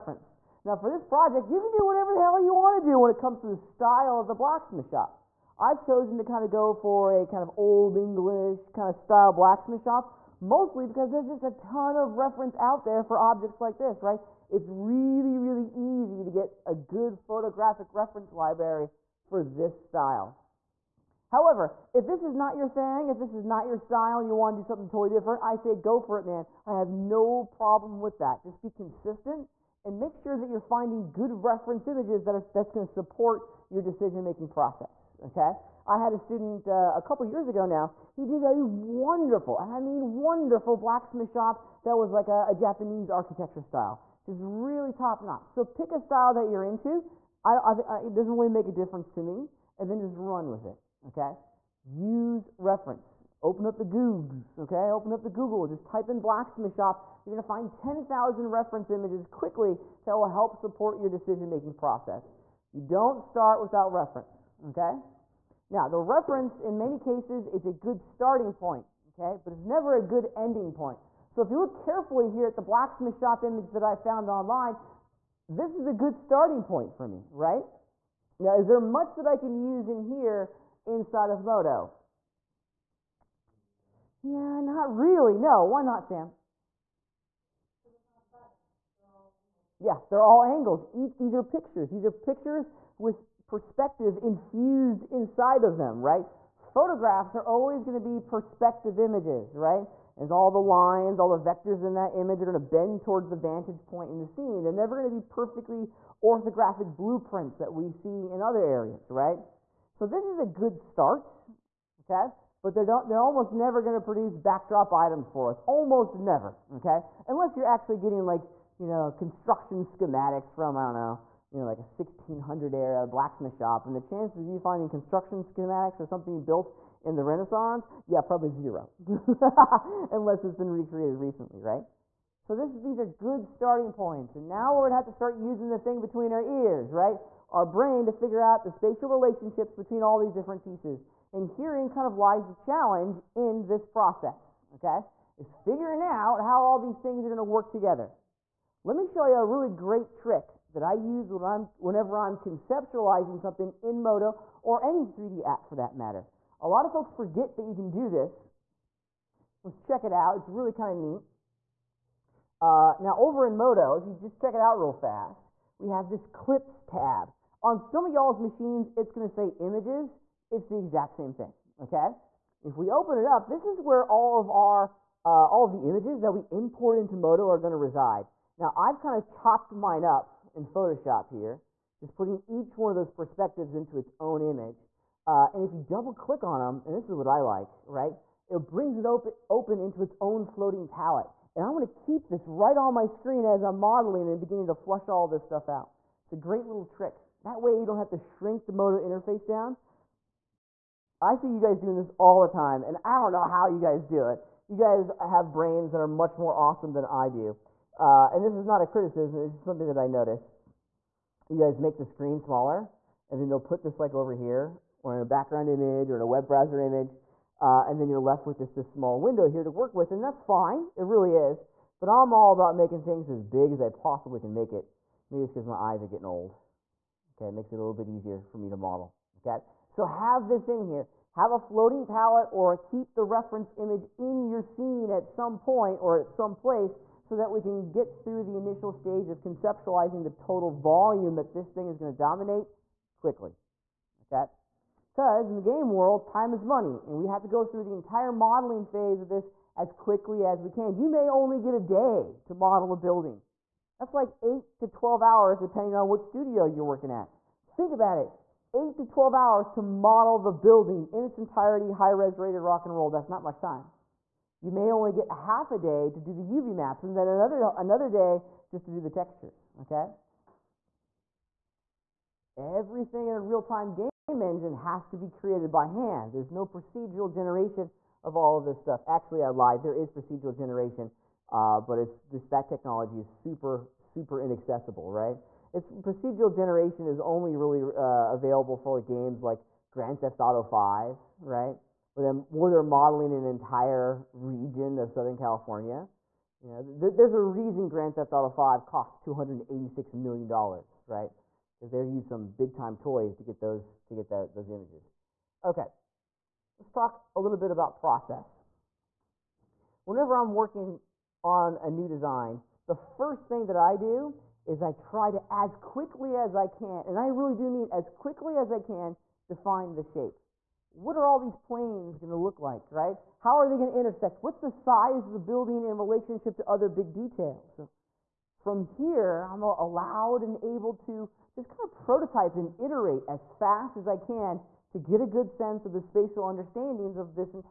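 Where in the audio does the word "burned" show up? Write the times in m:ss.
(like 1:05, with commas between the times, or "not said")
not said.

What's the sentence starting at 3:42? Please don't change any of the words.
But I'm all about making things as big as I possibly can make it.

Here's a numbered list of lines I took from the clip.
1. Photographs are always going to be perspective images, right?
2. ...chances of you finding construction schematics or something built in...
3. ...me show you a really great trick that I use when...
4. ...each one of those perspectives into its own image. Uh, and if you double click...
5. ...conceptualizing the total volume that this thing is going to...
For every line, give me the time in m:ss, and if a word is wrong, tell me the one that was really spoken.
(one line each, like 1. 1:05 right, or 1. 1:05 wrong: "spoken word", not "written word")
1. 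1:36 right
2. 2:04 right
3. 2:28 right
4. 3:02 right
5. 3:59 right.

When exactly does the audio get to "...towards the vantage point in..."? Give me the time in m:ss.
1:43.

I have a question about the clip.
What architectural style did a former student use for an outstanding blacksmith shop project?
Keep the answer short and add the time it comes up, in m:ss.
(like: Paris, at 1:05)
Japanese, at 0:42.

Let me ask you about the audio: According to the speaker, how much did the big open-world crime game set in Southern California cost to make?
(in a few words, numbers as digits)
286 million dollars.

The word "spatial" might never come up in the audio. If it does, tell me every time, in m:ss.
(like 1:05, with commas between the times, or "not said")
2:18, 5:36.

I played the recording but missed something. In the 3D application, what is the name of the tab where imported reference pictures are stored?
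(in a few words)
Clips.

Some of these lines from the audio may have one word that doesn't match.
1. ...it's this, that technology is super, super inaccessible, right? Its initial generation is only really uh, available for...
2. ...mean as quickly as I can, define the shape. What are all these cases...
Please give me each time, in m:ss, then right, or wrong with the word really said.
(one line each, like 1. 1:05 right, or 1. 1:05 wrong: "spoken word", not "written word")
1. 4:42 wrong: "procedural", not "initial"
2. 5:17 wrong: "planes", not "cases".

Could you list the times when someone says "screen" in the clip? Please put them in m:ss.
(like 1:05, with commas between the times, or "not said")
3:13, 3:32.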